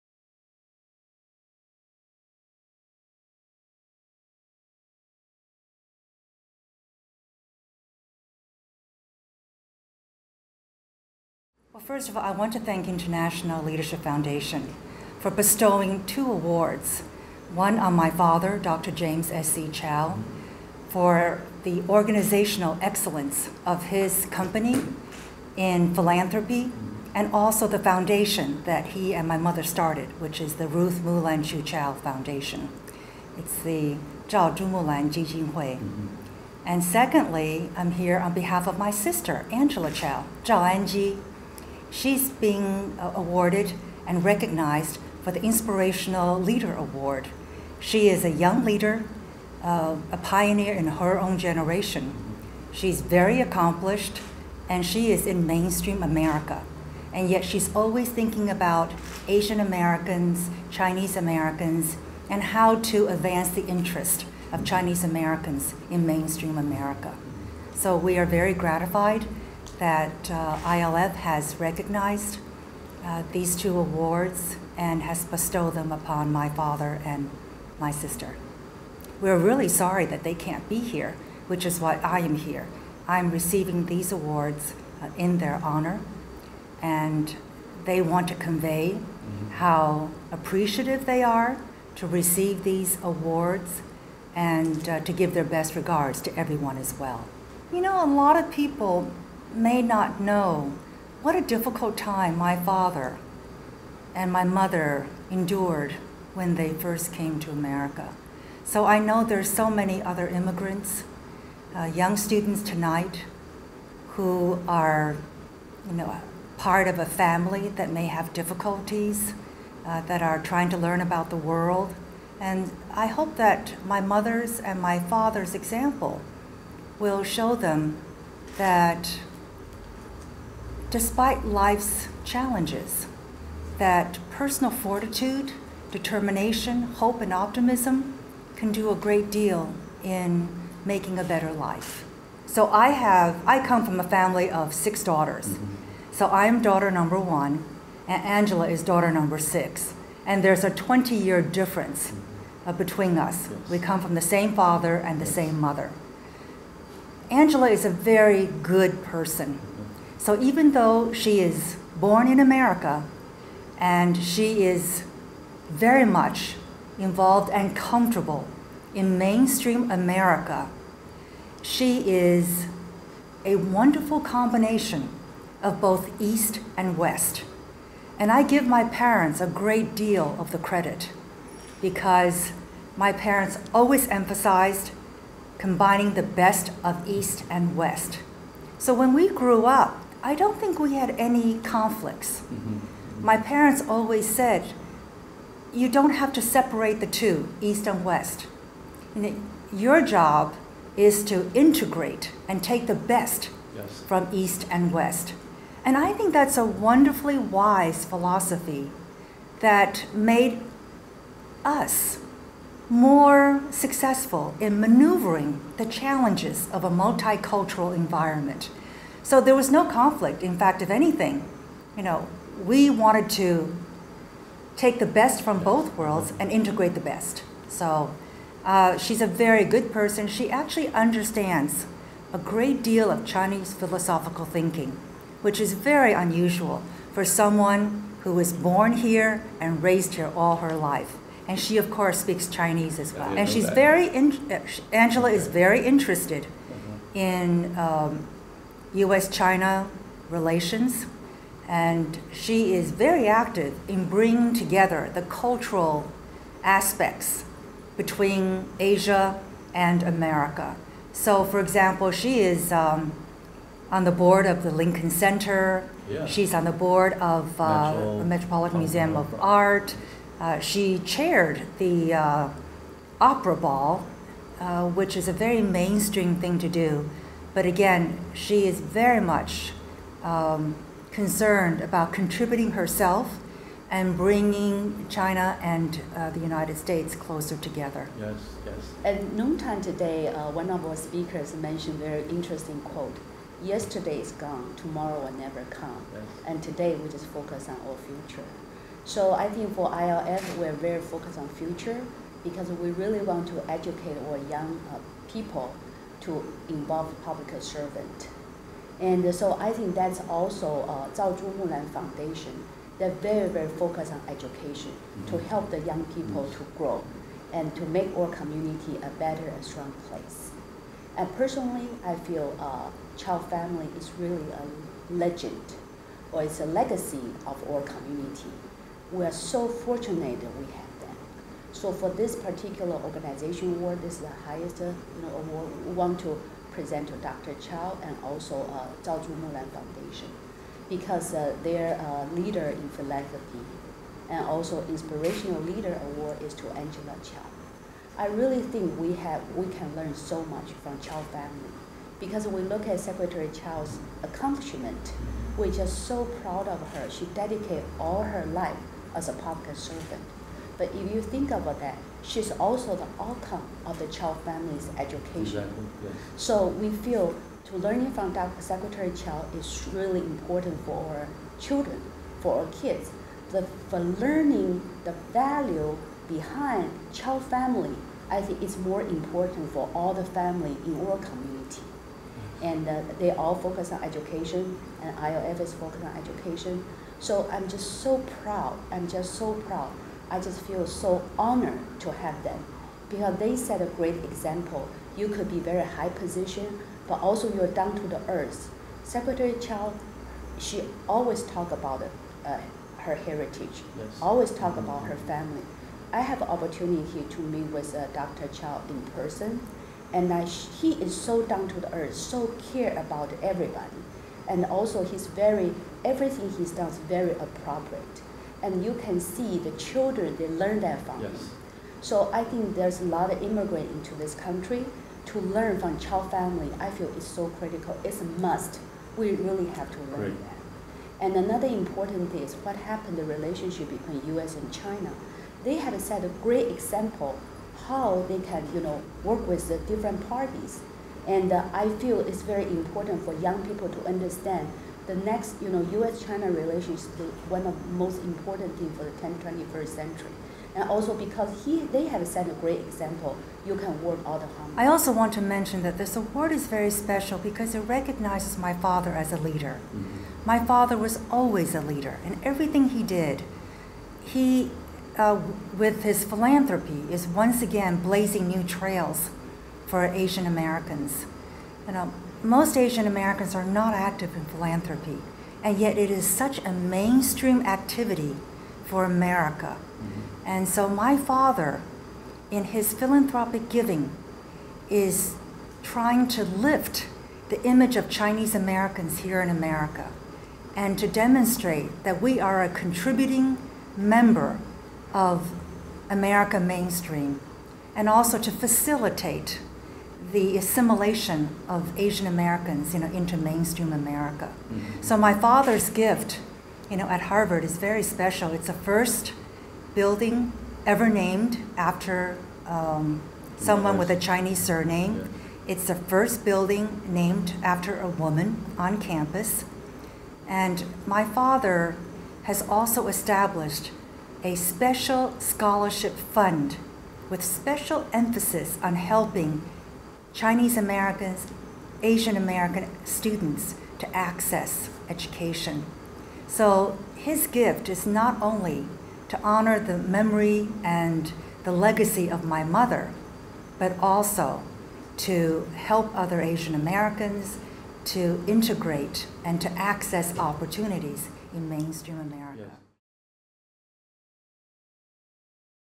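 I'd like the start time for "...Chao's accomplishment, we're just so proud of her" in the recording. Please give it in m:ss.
5:53.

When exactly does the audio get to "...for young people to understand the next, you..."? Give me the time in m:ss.
7:23.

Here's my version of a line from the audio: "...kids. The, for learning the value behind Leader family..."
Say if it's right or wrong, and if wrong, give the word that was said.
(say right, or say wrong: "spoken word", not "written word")
wrong: "Chao", not "Leader".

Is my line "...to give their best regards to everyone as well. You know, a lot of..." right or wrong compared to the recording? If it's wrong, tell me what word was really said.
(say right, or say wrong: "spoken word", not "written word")
right.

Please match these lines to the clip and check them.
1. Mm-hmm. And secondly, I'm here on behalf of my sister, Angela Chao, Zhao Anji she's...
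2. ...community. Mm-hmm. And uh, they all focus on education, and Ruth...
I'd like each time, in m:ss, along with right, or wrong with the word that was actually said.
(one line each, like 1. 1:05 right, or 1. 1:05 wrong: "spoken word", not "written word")
1. 0:35 right
2. 6:21 wrong: "ILF", not "Ruth".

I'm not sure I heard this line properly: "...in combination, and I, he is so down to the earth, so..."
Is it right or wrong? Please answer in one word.
wrong.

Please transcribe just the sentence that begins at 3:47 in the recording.
So uh, she's a very good person.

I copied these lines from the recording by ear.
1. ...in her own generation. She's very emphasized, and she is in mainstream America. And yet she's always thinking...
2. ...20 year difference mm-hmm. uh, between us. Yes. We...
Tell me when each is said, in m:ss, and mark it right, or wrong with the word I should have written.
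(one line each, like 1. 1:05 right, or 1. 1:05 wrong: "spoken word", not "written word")
1. 0:50 wrong: "accomplished", not "emphasized"
2. 2:30 right.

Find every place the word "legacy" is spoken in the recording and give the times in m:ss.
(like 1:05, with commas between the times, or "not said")
5:26, 9:01.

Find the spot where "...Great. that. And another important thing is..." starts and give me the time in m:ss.
7:10.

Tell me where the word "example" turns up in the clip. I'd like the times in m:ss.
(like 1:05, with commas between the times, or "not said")
2:05, 4:21, 6:34, 7:16, 7:32.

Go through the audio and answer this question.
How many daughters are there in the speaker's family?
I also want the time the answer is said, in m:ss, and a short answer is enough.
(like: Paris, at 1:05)
6, at 2:24.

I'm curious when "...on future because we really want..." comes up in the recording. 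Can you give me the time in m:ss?
5:01.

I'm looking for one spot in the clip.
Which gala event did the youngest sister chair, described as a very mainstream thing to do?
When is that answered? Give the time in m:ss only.
4:33.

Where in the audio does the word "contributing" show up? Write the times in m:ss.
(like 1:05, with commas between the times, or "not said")
4:42, 8:12.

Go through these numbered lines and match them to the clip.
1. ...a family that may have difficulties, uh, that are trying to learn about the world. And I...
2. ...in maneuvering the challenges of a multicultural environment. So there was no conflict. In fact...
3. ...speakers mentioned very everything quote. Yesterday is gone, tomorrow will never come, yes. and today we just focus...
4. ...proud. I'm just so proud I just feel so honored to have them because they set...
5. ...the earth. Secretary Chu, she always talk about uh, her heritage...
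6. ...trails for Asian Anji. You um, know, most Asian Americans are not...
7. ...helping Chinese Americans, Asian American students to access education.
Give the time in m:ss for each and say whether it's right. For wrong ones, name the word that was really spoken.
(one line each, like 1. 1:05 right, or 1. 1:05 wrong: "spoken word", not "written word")
1. 1:56 right
2. 3:34 right
3. 4:50 wrong: "interesting", not "everything"
4. 6:28 right
5. 6:38 wrong: "Chao", not "Chu"
6. 7:48 wrong: "Americans", not "Anji"
7. 8:48 right.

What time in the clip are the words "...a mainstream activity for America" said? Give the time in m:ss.
7:56.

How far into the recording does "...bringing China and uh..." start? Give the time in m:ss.
4:44.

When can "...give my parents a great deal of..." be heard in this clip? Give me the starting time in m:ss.
2:58.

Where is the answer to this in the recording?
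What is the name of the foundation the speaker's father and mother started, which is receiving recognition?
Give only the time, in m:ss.
0:30.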